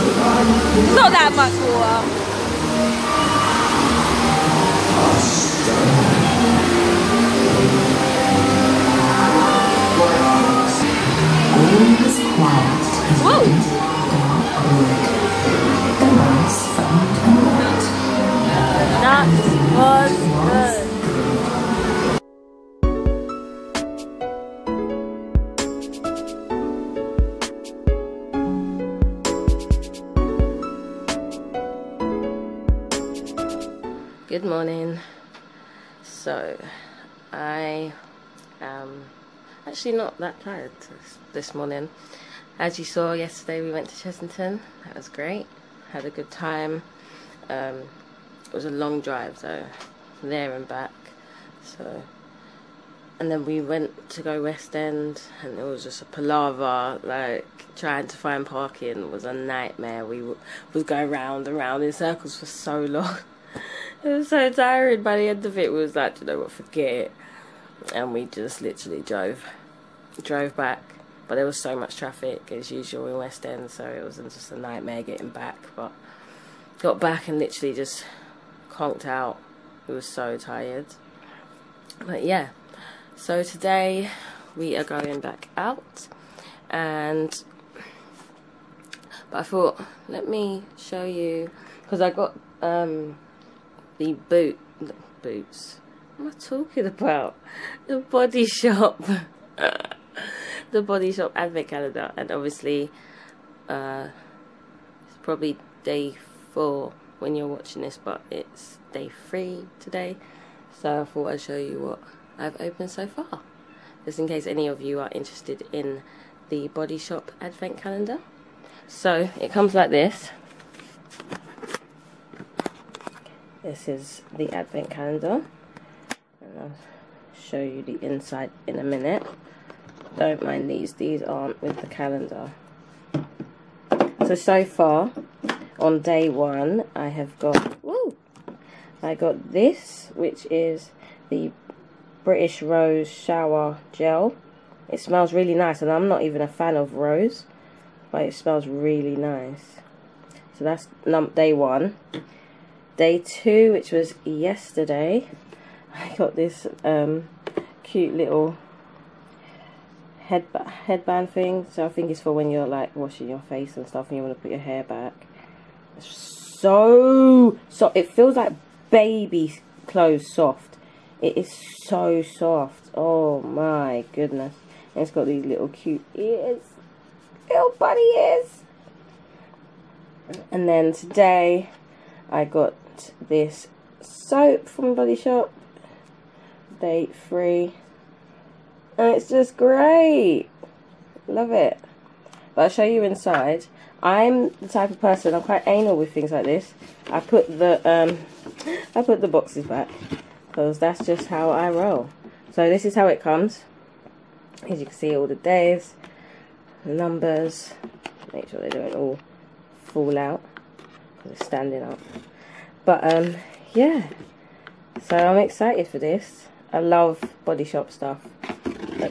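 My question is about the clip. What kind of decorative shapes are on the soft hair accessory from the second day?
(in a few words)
Bunny ears.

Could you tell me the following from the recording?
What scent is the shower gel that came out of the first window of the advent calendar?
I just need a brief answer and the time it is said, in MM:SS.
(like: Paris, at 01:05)
British Rose, at 02:22.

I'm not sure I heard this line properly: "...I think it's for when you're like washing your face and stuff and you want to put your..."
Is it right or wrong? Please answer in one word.
right.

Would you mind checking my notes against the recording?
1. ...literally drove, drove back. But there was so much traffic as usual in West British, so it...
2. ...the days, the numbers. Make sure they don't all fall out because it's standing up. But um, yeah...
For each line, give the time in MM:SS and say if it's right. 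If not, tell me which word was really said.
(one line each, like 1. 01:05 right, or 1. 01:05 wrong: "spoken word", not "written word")
1. 01:08 wrong: "End", not "British"
2. 03:25 right.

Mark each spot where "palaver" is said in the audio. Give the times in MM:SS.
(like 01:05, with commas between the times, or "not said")
00:56.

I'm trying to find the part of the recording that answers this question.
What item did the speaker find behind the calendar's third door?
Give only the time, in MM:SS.
03:04.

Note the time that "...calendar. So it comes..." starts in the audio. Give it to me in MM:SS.
01:57.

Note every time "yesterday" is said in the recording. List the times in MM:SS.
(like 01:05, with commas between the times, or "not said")
00:43, 02:34.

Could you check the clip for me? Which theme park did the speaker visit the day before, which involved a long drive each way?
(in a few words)
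Chessington.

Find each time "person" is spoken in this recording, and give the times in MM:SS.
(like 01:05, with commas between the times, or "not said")
03:14.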